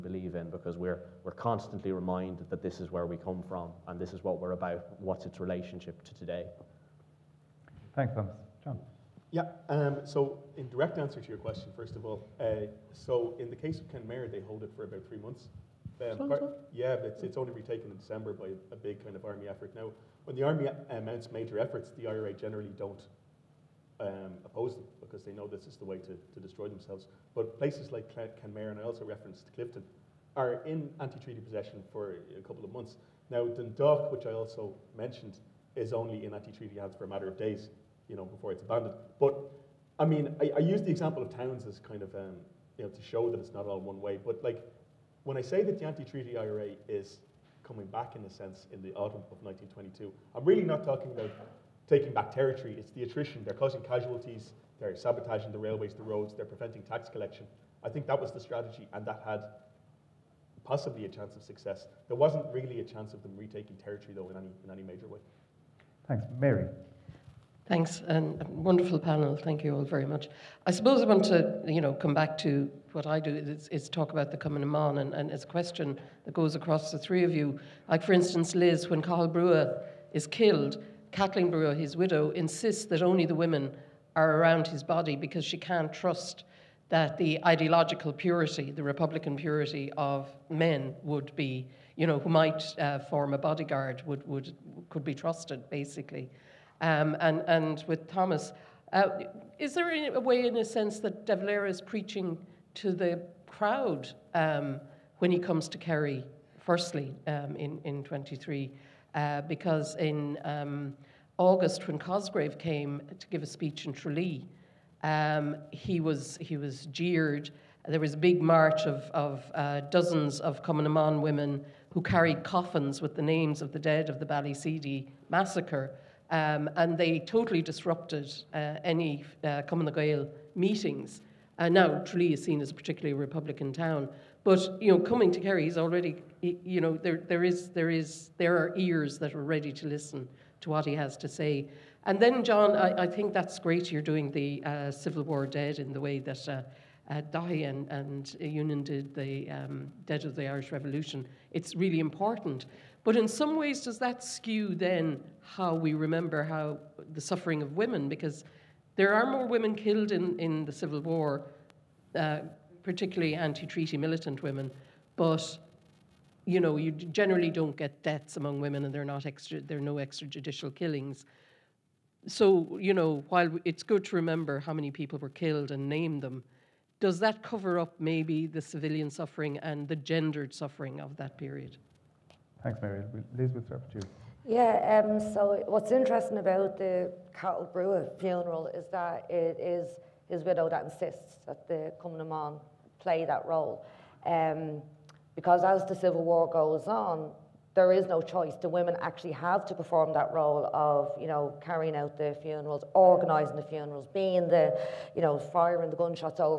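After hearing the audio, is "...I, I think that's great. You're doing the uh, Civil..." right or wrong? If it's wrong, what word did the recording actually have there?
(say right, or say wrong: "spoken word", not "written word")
right.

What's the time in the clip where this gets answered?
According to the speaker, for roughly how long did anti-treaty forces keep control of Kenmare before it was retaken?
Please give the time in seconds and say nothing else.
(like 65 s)
14 s.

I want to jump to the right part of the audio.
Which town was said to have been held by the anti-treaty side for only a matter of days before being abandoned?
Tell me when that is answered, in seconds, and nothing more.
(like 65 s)
33 s.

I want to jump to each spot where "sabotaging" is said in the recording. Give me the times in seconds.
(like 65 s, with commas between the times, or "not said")
54 s.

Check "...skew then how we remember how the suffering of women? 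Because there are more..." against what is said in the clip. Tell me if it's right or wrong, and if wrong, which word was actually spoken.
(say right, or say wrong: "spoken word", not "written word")
right.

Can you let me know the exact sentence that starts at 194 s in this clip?
Um, because as the Civil War goes on, there is no choice.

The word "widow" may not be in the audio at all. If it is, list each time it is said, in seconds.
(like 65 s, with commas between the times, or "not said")
81 s, 190 s.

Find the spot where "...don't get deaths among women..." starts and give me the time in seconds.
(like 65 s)
167 s.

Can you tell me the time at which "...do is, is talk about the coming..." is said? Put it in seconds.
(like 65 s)
73 s.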